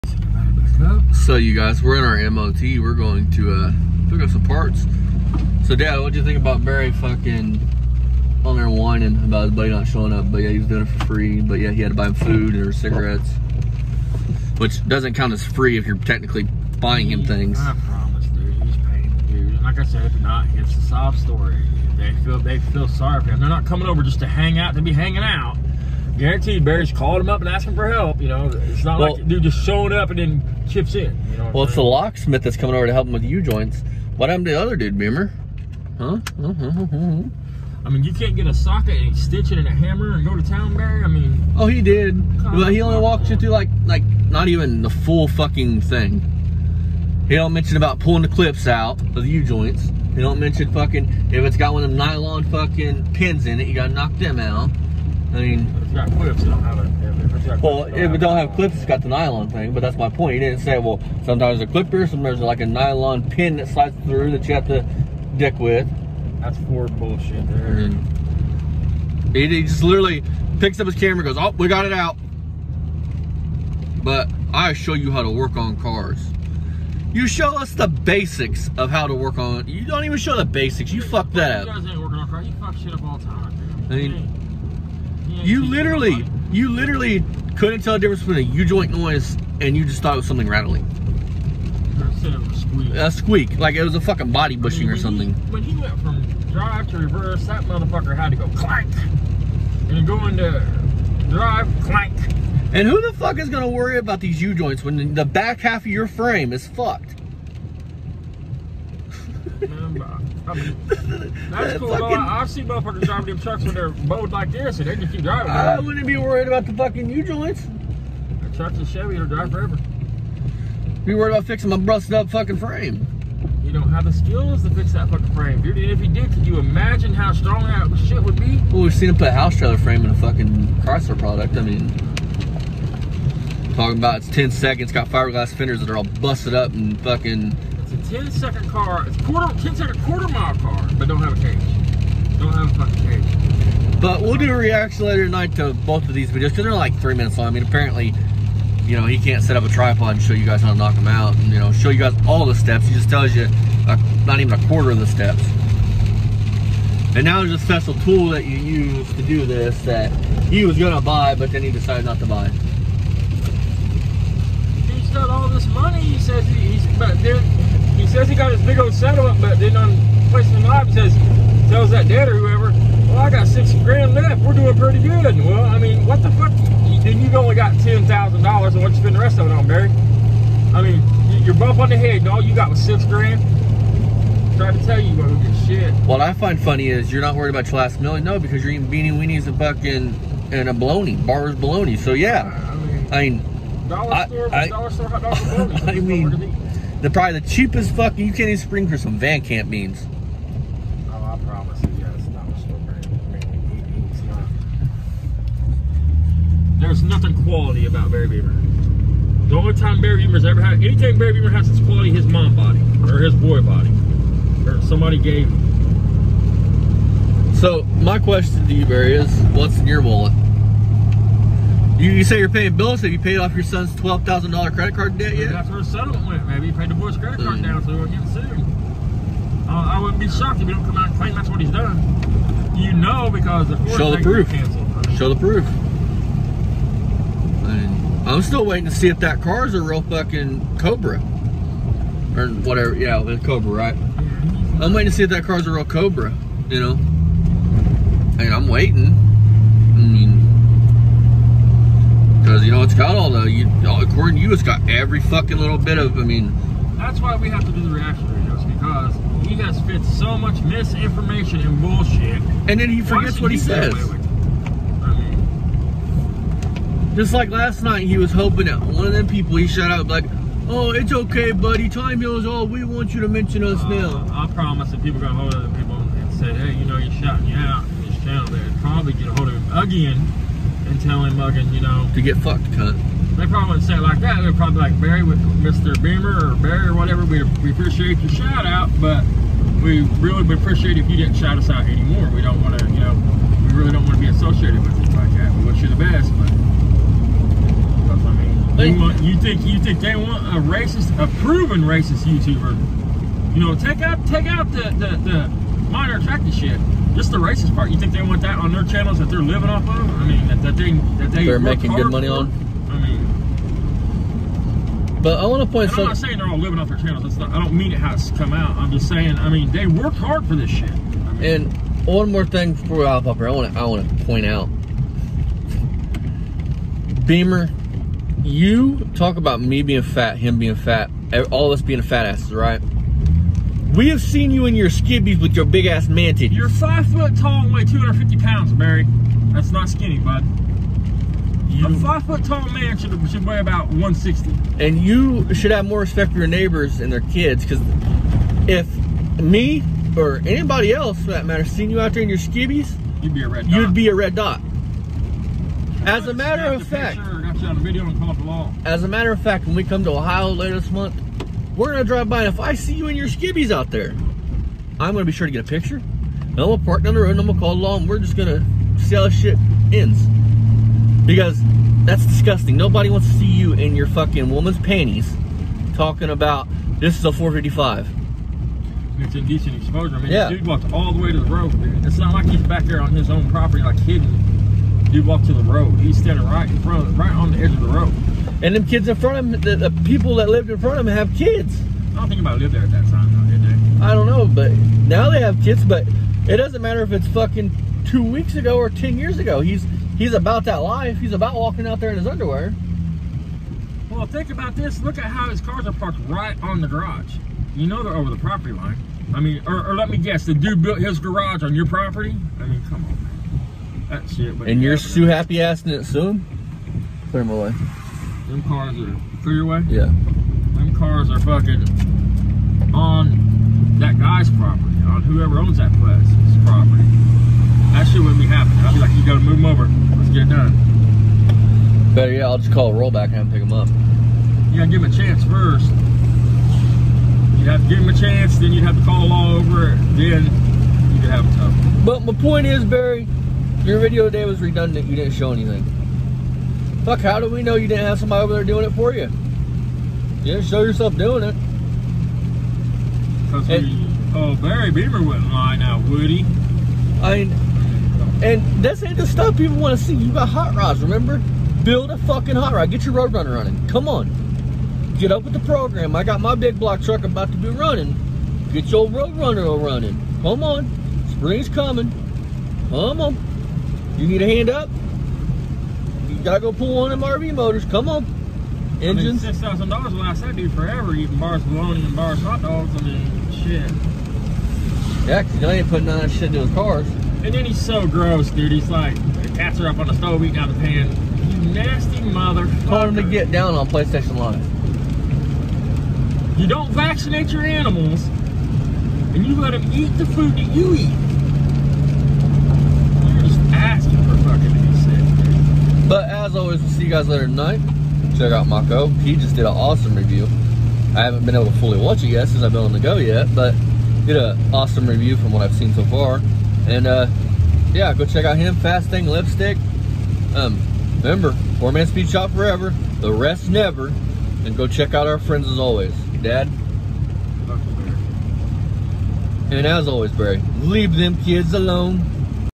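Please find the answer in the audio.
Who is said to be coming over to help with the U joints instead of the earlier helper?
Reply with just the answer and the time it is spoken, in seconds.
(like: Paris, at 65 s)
The locksmith, at 31 s.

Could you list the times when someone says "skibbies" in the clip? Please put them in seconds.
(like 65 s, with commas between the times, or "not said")
334 s, 352 s, 363 s.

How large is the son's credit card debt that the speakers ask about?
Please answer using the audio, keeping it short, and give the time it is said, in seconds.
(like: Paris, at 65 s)
$12,000, at 223 s.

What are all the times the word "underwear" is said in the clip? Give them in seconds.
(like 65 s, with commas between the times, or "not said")
402 s.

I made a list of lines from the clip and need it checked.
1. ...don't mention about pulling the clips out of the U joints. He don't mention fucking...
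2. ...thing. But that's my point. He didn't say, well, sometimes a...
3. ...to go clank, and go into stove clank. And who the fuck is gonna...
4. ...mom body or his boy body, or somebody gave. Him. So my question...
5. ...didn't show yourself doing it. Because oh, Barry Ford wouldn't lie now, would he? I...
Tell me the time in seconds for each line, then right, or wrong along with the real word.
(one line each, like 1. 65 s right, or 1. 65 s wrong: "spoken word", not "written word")
1. 47 s right
2. 59 s right
3. 98 s wrong: "drive", not "stove"
4. 212 s right
5. 450 s wrong: "Beamer", not "Ford".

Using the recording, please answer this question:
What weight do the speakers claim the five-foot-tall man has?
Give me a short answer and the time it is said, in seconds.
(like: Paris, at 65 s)
250 pounds, at 337 s.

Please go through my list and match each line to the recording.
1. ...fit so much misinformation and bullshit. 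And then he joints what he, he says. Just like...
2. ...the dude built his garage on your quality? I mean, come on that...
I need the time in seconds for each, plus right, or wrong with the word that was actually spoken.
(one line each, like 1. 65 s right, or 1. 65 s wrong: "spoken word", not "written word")
1. 259 s wrong: "forgets", not "joints"
2. 410 s wrong: "property", not "quality".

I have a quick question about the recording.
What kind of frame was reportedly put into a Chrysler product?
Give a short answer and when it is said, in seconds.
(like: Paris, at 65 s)
A house trailer frame, at 129 s.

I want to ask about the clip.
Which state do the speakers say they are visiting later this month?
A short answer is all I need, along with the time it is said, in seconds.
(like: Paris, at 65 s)
Ohio, at 360 s.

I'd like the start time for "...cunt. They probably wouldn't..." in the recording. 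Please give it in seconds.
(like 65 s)
282 s.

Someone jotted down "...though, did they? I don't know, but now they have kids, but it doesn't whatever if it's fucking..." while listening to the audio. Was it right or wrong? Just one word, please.
wrong.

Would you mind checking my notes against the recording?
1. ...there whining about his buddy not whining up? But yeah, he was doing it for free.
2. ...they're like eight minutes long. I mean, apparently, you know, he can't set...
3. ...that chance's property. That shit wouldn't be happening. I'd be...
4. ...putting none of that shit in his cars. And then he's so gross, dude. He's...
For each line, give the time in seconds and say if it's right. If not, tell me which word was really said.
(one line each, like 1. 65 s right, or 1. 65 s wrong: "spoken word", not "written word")
1. 8 s wrong: "showing", not "whining"
2. 146 s wrong: "three", not "eight"
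3. 425 s wrong: "place", not "chance"
4. 485 s right.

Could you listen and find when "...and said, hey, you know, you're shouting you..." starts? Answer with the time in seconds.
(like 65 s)
275 s.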